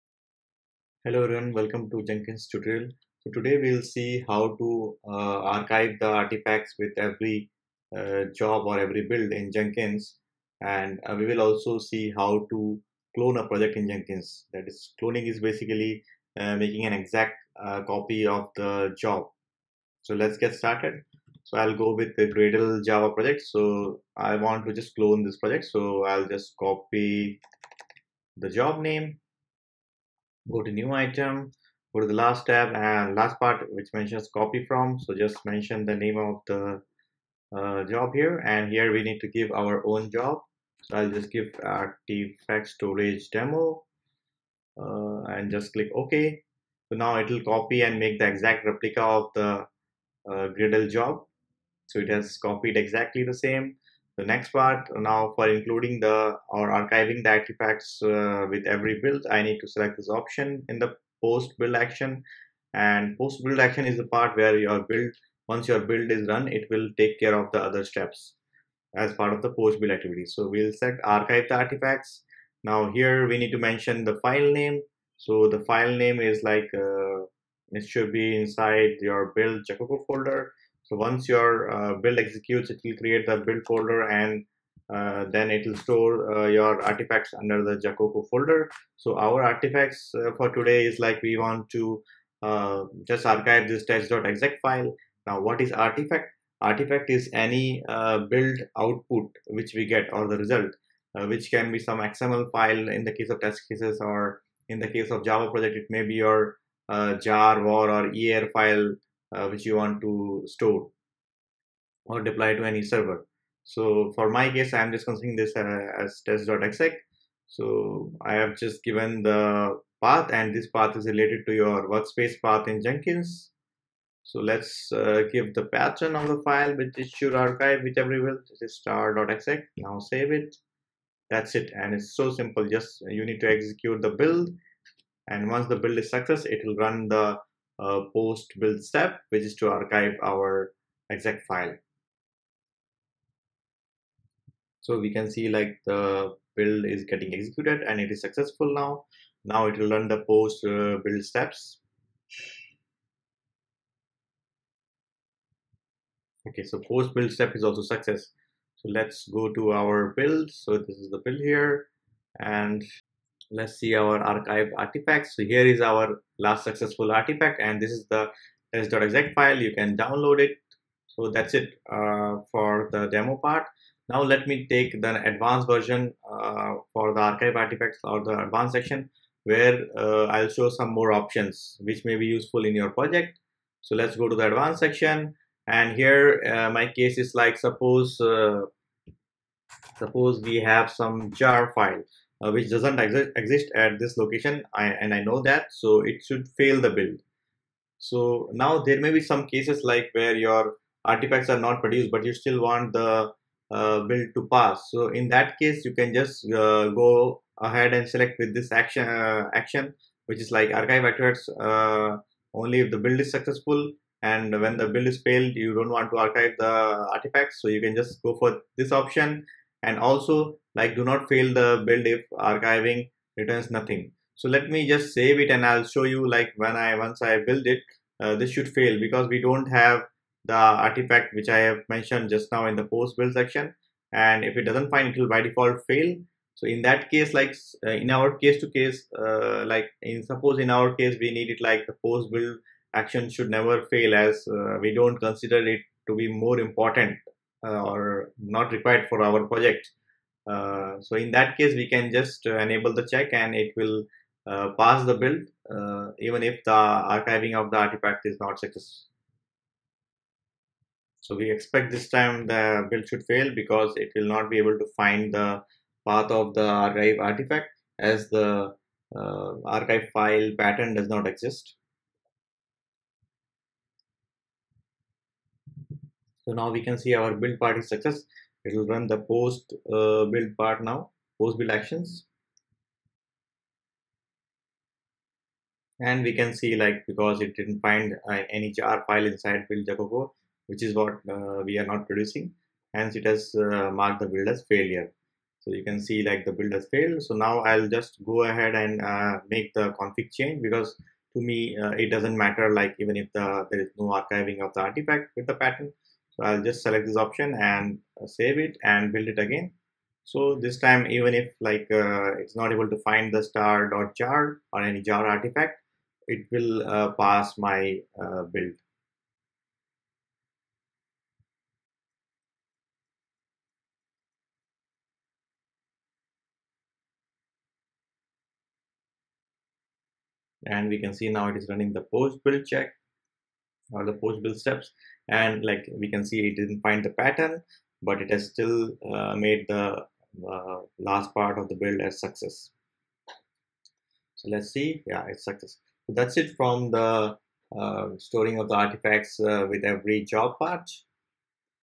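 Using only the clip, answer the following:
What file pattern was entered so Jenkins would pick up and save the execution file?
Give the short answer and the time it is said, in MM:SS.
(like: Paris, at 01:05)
*.exec, at 02:08.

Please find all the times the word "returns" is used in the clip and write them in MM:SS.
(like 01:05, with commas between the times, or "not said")
03:43.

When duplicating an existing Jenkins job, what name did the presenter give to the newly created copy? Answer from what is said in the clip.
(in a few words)
artifact storage demo.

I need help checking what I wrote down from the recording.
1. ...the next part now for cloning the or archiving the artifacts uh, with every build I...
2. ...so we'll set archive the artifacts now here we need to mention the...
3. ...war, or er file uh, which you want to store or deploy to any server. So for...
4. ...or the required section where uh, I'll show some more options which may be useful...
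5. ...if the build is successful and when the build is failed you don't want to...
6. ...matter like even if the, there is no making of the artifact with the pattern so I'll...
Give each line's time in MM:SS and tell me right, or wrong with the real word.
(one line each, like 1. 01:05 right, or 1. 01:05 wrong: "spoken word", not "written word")
1. 00:54 wrong: "including", not "cloning"
2. 01:10 right
3. 01:47 right
4. 02:58 wrong: "advanced", not "required"
5. 03:32 right
6. 05:02 wrong: "archiving", not "making".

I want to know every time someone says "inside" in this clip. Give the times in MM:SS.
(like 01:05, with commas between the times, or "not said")
01:18, 04:49.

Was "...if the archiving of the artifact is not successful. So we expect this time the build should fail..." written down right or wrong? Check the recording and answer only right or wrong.
right.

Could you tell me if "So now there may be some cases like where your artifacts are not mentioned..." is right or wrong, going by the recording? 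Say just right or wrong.
wrong.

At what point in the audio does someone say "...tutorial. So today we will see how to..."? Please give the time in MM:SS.
00:02.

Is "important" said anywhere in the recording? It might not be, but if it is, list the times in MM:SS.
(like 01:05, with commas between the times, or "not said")
04:06.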